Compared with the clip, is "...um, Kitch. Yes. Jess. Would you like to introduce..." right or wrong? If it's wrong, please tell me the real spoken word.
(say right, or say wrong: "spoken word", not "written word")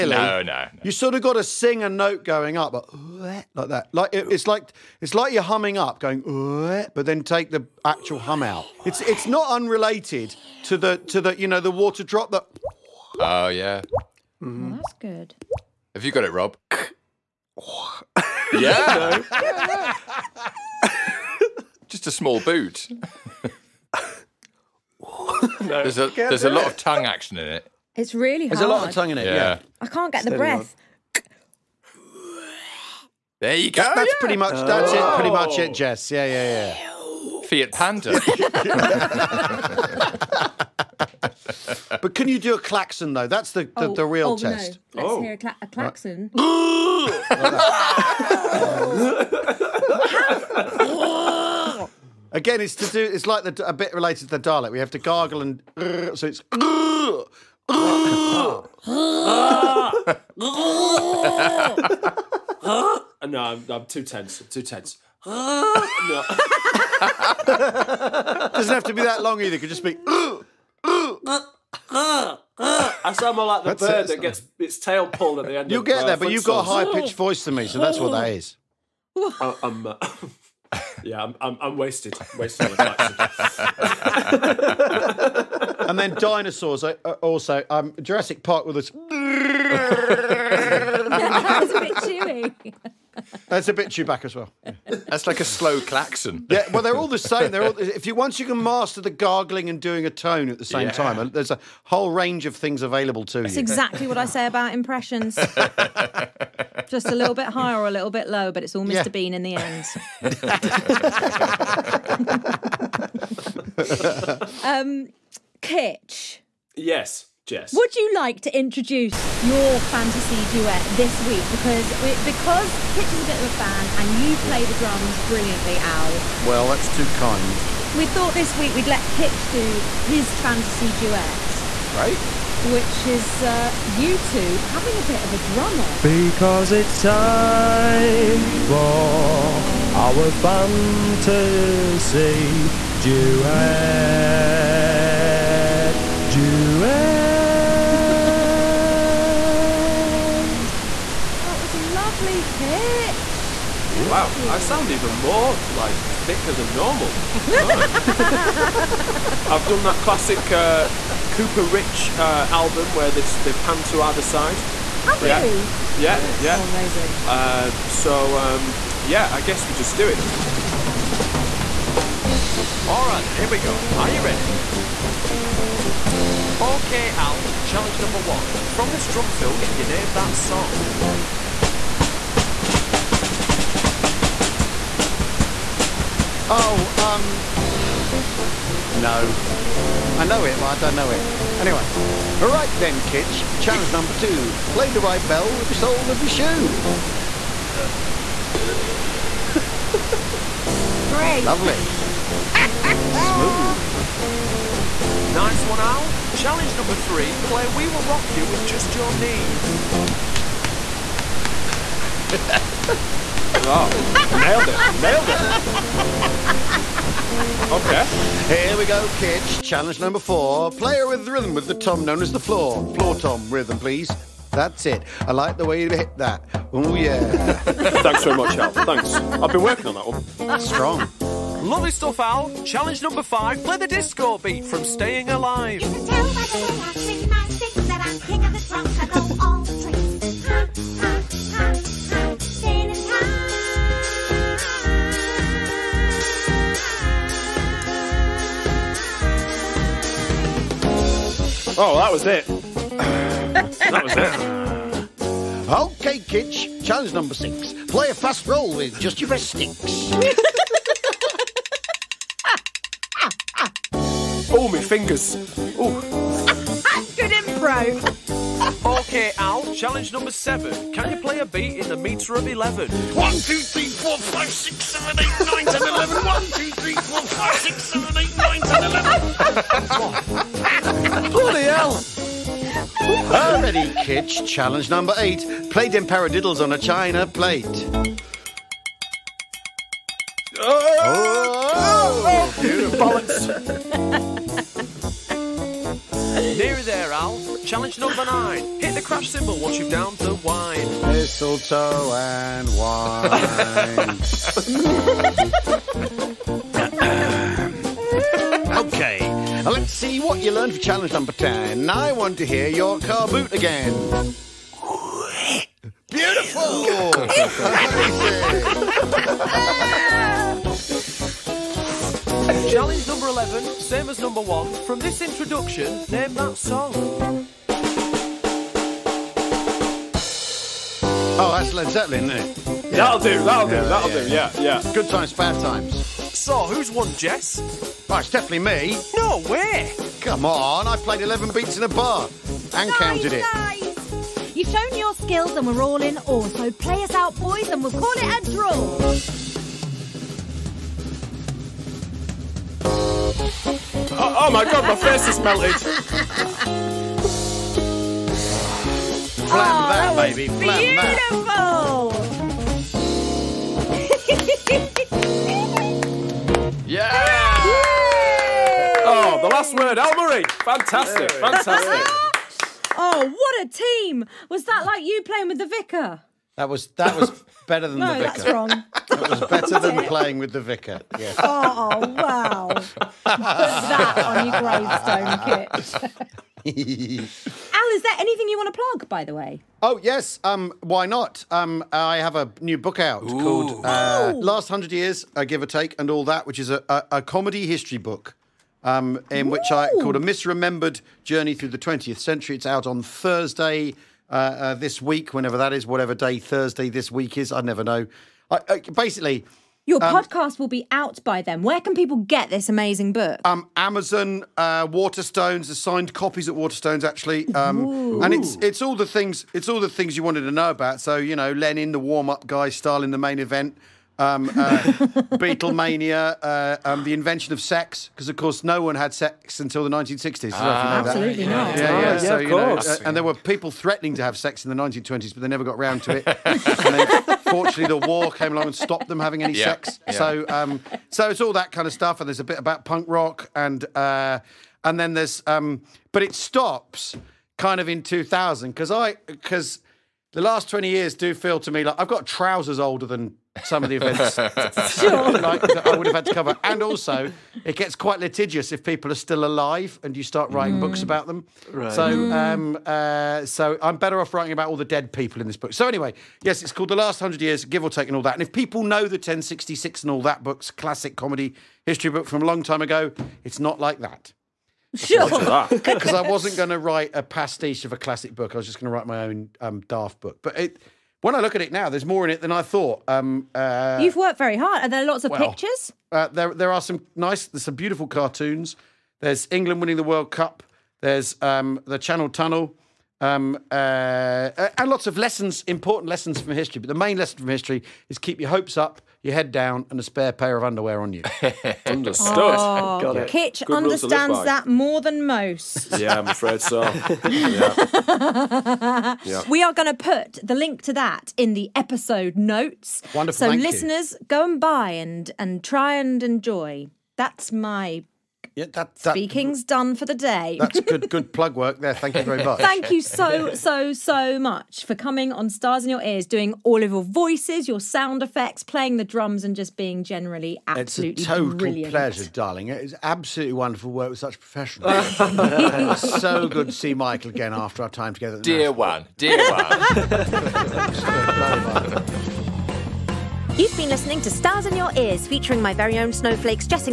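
right.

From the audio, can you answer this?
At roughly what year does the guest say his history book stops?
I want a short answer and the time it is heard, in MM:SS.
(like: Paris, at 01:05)
2000, at 07:28.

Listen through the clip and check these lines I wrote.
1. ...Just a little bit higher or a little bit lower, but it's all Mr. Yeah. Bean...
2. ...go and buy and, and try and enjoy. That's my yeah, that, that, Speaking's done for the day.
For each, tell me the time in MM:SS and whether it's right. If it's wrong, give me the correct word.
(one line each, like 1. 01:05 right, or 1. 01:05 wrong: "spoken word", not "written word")
1. 01:46 right
2. 08:34 right.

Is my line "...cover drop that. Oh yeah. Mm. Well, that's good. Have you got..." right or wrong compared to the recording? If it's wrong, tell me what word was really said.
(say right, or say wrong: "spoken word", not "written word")
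wrong: "water", not "cover".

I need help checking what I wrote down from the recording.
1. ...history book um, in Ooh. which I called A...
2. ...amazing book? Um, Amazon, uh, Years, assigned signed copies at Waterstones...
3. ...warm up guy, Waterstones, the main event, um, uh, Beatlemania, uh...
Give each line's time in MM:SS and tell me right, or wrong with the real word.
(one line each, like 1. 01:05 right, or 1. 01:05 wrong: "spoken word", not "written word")
1. 06:37 right
2. 06:52 wrong: "Waterstones", not "Years"
3. 07:01 wrong: "Stalin", not "Waterstones".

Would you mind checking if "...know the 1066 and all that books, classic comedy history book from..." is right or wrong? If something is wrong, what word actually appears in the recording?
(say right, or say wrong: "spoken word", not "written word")
right.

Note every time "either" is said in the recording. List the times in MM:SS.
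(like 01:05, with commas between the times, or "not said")
01:09, 02:44.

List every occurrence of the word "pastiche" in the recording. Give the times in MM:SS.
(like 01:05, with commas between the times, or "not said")
07:57.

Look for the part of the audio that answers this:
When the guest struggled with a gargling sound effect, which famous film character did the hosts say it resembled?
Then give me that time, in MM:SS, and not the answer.
01:33.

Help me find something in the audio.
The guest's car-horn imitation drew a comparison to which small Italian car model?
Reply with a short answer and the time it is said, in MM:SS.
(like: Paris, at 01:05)
Fiat Panda, at 00:37.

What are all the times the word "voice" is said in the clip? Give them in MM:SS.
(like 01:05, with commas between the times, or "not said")
01:17, 08:47.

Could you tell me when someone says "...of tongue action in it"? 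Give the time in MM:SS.
00:26.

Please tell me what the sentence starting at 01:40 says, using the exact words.
time, there's a whole range of things available to That's you.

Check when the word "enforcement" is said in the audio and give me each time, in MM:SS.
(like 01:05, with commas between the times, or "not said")
not said.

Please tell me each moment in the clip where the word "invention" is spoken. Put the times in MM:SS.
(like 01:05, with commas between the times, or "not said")
07:07.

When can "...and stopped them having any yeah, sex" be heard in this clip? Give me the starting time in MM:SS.
07:18.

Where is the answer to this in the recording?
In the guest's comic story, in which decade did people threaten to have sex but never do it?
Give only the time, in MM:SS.
07:14.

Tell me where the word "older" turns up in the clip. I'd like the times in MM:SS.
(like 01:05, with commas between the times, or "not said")
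07:32.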